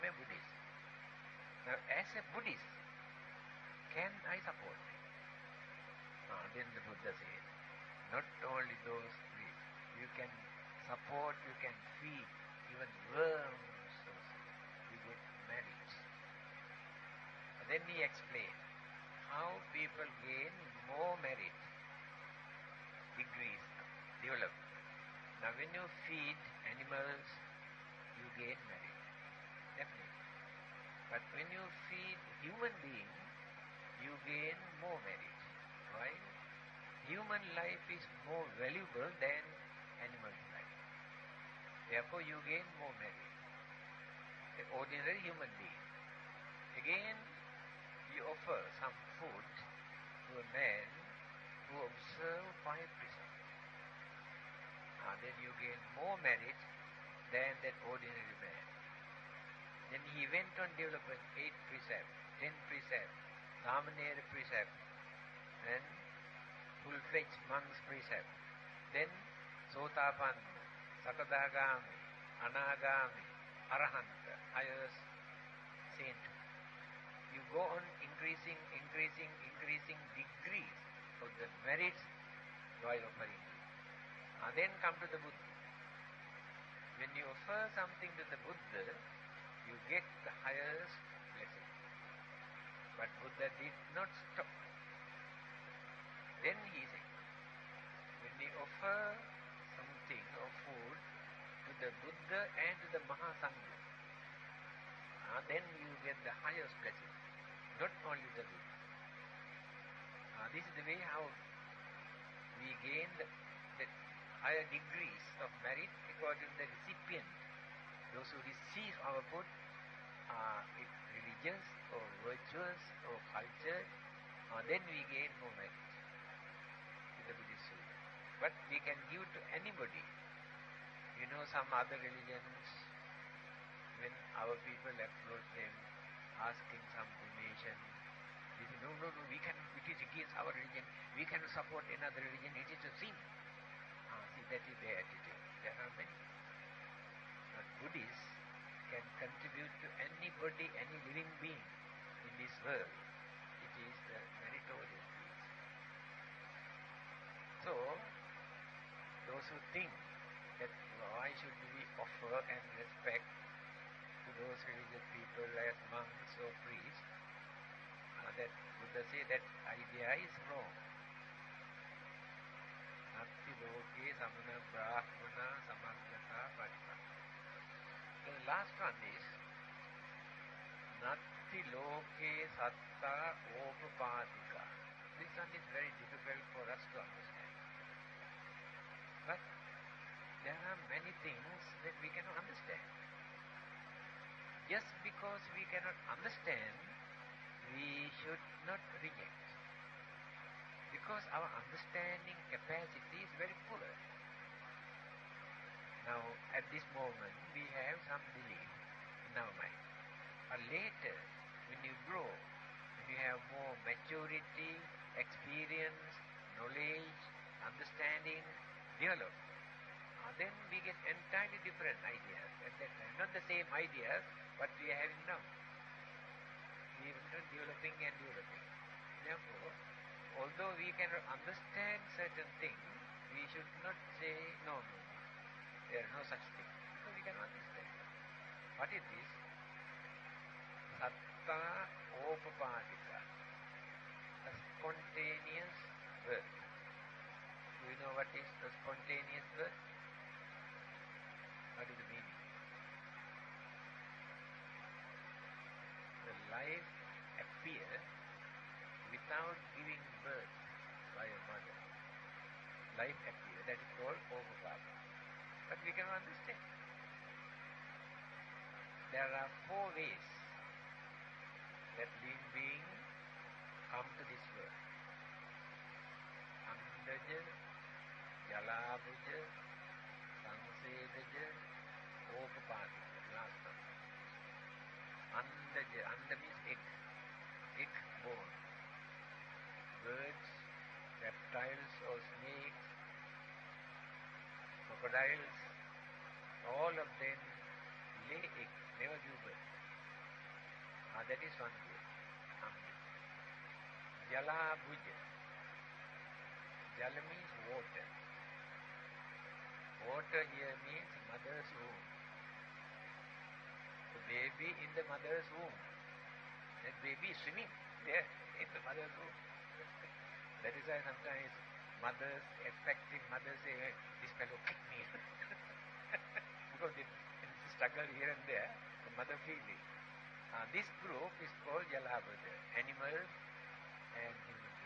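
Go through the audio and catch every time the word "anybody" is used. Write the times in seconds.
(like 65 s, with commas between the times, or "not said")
129 s, 150 s.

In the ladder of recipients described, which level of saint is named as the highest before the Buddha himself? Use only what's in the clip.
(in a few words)
Arahanta.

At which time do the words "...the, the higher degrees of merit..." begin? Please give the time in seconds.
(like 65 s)
113 s.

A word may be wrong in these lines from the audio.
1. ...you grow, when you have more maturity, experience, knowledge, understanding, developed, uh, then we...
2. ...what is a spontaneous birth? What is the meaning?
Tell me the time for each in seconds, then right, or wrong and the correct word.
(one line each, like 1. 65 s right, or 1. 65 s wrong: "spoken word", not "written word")
1. 211 s right
2. 248 s right.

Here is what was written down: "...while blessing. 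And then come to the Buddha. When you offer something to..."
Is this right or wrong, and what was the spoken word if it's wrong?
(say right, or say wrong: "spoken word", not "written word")
wrong: "offering", not "blessing".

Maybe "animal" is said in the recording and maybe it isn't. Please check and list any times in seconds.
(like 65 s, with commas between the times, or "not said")
26 s, 40 s, 332 s.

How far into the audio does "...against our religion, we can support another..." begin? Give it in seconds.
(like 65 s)
140 s.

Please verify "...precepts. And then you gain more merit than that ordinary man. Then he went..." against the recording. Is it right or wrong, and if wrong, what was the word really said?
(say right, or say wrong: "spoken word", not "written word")
right.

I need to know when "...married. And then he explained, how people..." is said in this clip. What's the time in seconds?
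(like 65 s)
15 s.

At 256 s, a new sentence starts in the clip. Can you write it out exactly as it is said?
The life appears without giving birth by a mother.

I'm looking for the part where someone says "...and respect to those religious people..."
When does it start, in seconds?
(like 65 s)
162 s.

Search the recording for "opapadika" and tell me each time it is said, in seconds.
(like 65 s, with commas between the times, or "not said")
183 s, 242 s.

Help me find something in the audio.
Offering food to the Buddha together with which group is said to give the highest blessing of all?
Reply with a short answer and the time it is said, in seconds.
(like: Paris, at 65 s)
Mahasangha, at 103 s.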